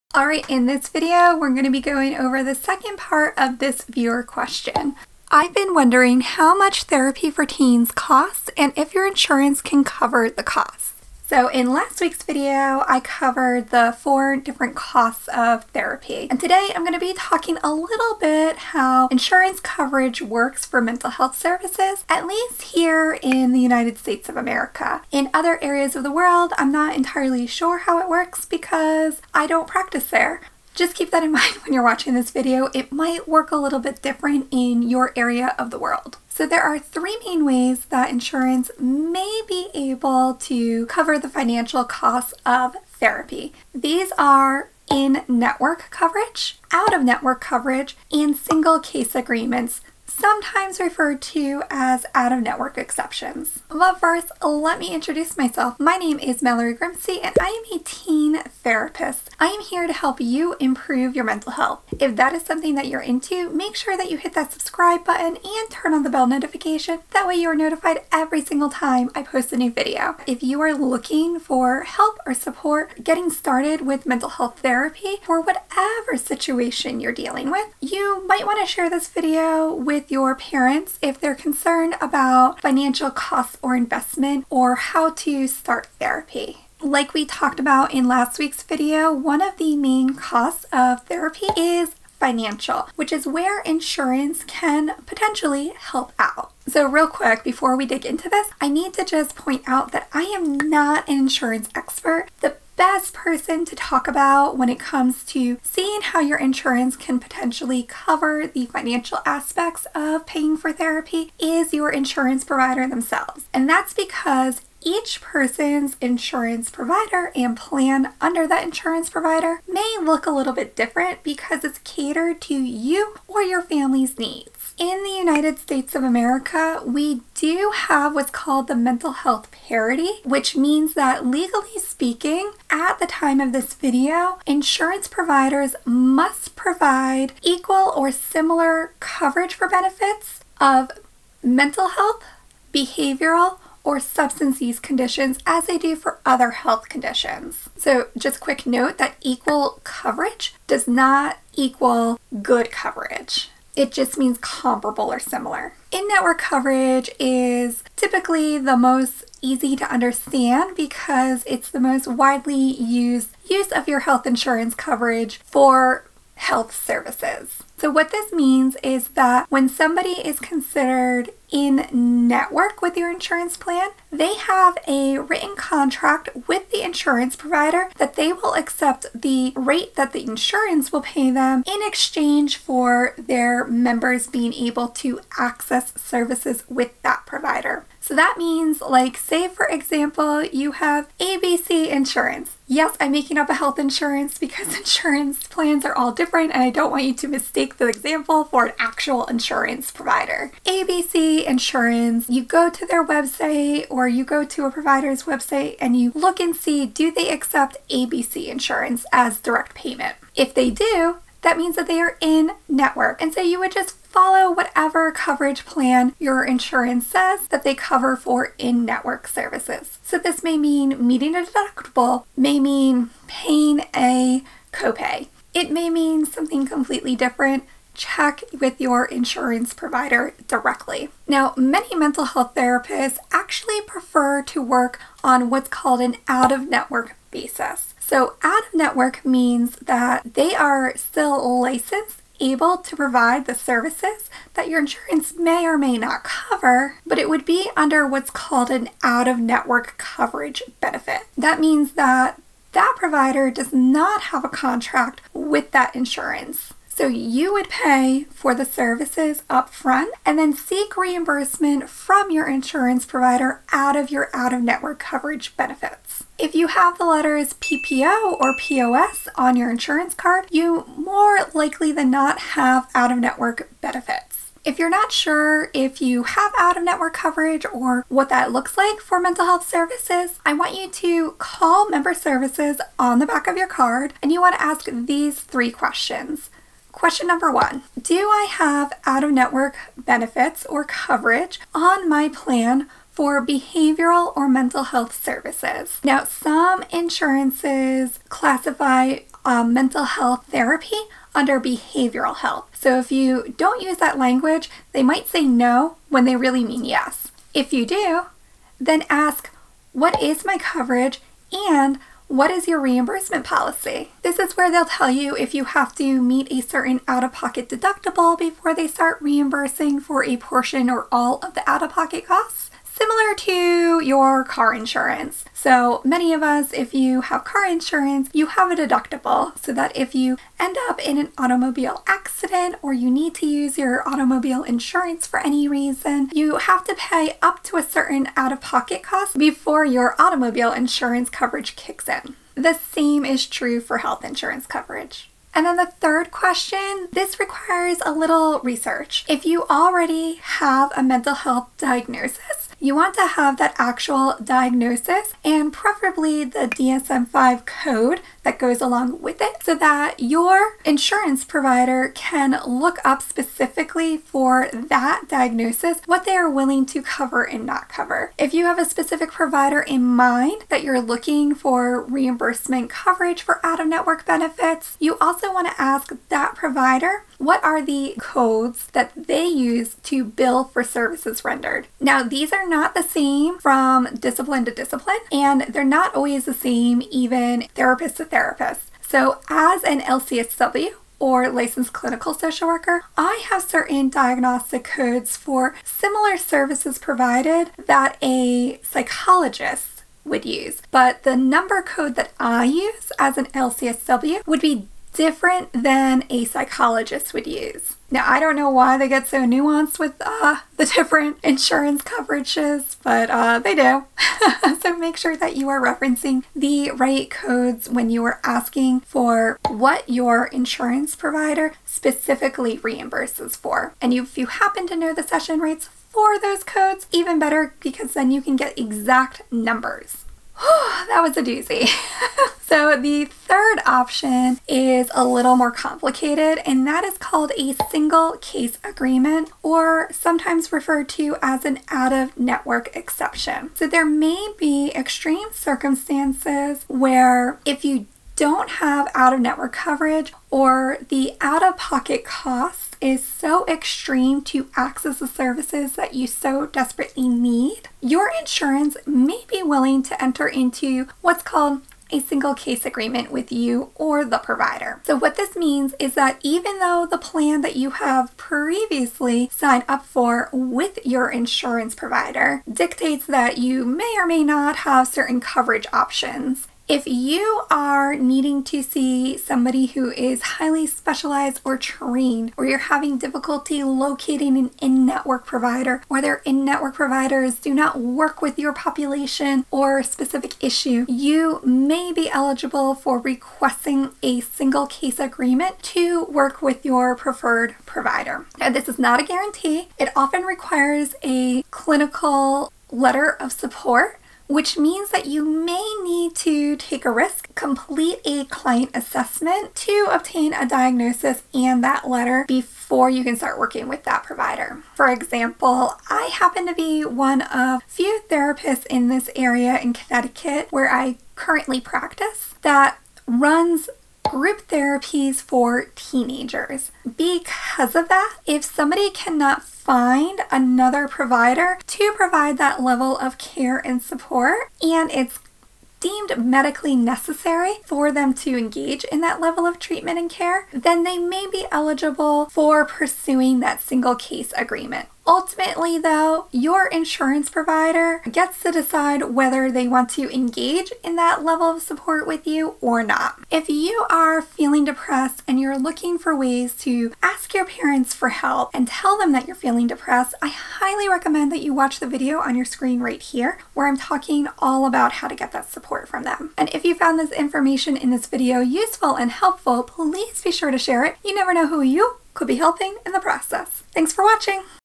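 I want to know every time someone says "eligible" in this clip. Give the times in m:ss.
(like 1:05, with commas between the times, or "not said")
8:12, 9:01.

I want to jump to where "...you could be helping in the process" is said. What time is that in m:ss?
9:31.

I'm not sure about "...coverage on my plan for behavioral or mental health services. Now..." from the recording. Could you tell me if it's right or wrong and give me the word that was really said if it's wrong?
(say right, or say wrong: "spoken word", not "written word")
right.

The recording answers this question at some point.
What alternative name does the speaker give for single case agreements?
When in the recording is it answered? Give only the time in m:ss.
0:52.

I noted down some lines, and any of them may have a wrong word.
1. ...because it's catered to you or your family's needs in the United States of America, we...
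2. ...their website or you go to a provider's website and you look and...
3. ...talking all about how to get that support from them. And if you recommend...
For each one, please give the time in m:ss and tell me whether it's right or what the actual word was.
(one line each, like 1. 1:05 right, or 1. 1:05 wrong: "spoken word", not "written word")
1. 2:01 right
2. 3:22 right
3. 9:23 wrong: "found", not "recommend".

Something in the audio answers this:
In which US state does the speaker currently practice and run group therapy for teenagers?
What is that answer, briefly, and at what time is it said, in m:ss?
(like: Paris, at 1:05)
Connecticut, at 8:39.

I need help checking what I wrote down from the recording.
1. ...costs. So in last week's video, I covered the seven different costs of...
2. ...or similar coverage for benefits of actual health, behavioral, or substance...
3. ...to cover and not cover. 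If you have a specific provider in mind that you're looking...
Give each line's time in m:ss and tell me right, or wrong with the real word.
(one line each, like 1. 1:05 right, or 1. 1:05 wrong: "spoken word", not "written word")
1. 0:10 wrong: "four", not "seven"
2. 2:17 wrong: "mental", not "actual"
3. 6:06 right.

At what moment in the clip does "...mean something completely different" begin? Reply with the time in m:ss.
3:45.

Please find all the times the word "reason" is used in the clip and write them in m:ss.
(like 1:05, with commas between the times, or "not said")
5:35.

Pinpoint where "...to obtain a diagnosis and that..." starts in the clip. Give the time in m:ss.
8:29.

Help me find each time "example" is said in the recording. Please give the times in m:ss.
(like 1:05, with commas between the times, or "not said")
3:09, 3:17, 8:35.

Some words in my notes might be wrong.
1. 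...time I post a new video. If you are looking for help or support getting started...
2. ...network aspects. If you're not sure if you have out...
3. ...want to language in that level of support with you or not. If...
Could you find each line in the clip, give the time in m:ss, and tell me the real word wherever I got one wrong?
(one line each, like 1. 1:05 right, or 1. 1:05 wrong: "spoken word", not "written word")
1. 1:08 right
2. 4:33 wrong: "benefits", not "aspects"
3. 9:09 wrong: "engage", not "language".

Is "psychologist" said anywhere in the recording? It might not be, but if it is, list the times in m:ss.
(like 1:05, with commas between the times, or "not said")
6:38, 6:46.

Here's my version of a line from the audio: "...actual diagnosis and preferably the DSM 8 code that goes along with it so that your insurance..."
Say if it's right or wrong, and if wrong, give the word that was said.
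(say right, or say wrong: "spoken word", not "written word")
wrong: "5", not "8".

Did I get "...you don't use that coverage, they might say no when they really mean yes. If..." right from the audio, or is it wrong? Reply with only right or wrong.
wrong.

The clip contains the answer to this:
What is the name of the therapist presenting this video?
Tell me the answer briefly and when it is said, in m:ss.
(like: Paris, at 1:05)
Mallory Grimste, at 0:56.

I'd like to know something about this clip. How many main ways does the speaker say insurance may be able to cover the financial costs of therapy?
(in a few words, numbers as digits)
3.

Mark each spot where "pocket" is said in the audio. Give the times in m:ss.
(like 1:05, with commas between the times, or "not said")
5:17, 5:21, 5:38, 7:31.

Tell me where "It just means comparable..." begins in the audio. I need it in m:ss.
2:33.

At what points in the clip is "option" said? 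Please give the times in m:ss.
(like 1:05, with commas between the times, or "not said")
7:13, 7:55.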